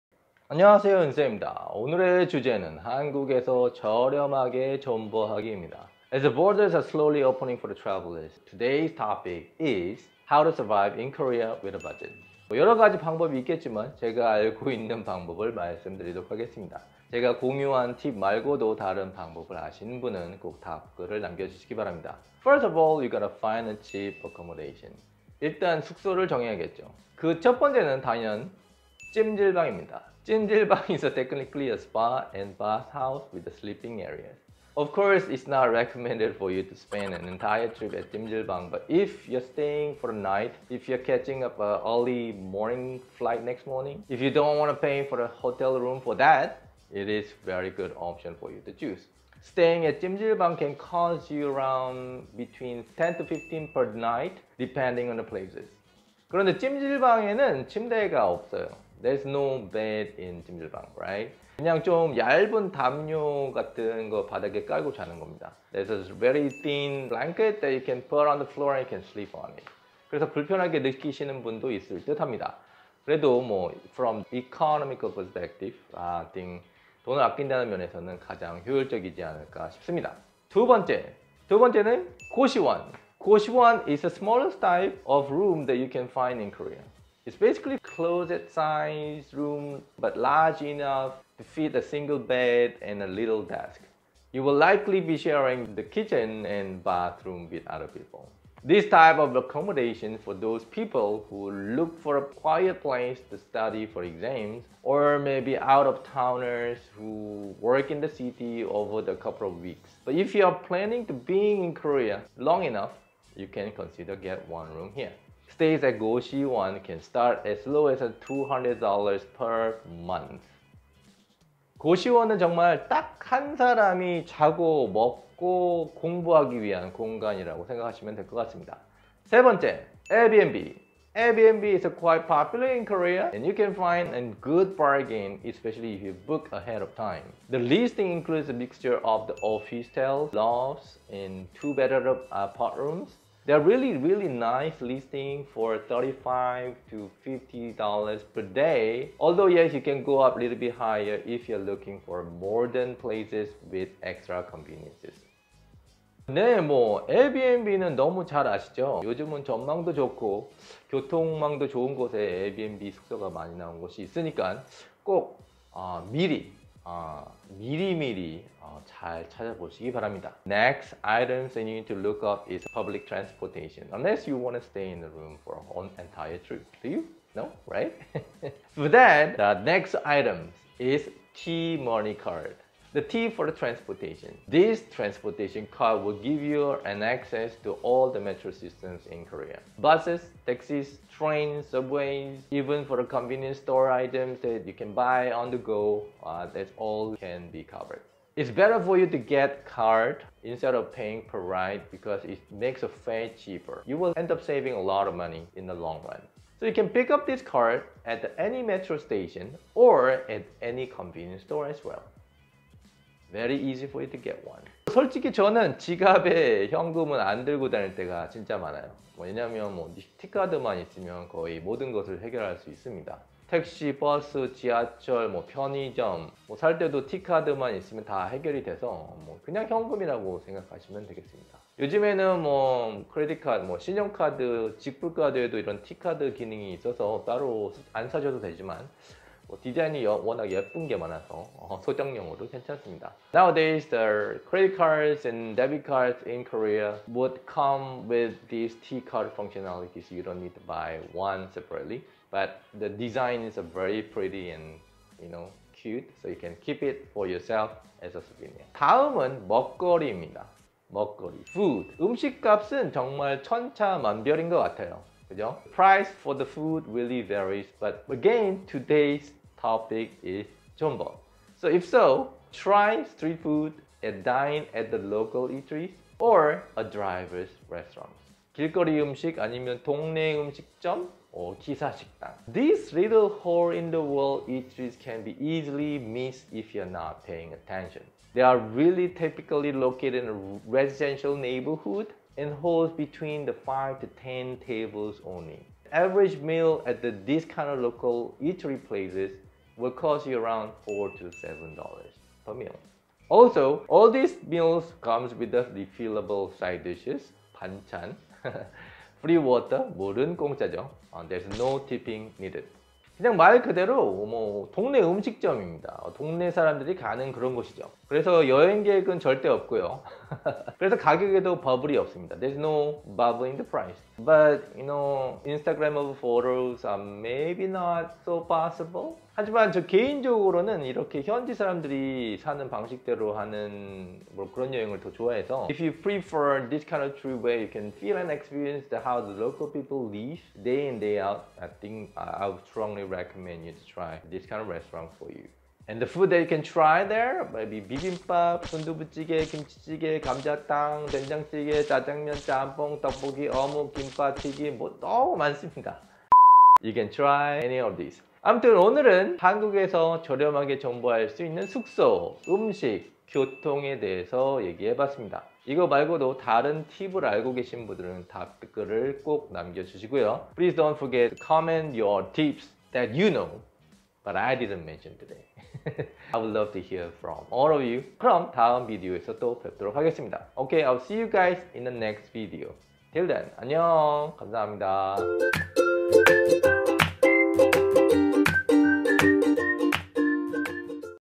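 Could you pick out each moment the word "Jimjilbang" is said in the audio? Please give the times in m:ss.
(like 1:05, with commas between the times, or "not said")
0:30, 0:38, 0:50.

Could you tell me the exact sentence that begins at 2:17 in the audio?
The listing includes a mixture of the office towels, lofts, and two-bedroom apart rooms.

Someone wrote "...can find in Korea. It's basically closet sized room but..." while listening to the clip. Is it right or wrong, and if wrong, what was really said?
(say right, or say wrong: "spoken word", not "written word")
right.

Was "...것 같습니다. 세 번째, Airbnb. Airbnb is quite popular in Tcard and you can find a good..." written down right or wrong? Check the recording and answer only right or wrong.
wrong.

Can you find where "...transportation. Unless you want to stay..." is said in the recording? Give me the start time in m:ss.
2:53.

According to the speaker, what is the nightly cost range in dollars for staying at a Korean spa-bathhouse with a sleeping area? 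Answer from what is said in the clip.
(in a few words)
10 to 15.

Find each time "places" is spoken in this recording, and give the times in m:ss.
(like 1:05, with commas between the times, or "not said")
0:55, 1:42, 2:32, 4:58.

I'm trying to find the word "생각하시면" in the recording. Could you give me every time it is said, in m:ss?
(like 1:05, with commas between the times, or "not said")
2:07, 3:50.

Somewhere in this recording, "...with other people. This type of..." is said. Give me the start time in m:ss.
1:37.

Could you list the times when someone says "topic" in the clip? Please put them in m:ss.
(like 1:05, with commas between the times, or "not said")
0:08, 4:29.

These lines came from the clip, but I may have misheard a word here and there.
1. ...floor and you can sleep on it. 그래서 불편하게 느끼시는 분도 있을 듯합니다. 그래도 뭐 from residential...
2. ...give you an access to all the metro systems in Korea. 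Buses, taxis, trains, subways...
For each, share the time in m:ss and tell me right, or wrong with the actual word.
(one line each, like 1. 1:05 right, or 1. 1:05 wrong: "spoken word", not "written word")
1. 1:08 wrong: "economical", not "residential"
2. 3:06 right.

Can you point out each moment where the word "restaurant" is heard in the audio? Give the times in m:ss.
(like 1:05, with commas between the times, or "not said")
4:37, 5:44.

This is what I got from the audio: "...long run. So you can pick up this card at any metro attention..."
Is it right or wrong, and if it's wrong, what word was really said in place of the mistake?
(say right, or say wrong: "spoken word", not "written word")
wrong: "station", not "attention".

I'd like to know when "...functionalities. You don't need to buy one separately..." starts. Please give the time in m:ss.
4:09.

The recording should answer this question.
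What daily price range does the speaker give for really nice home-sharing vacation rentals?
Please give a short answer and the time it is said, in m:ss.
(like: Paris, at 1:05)
35 to $50, at 2:25.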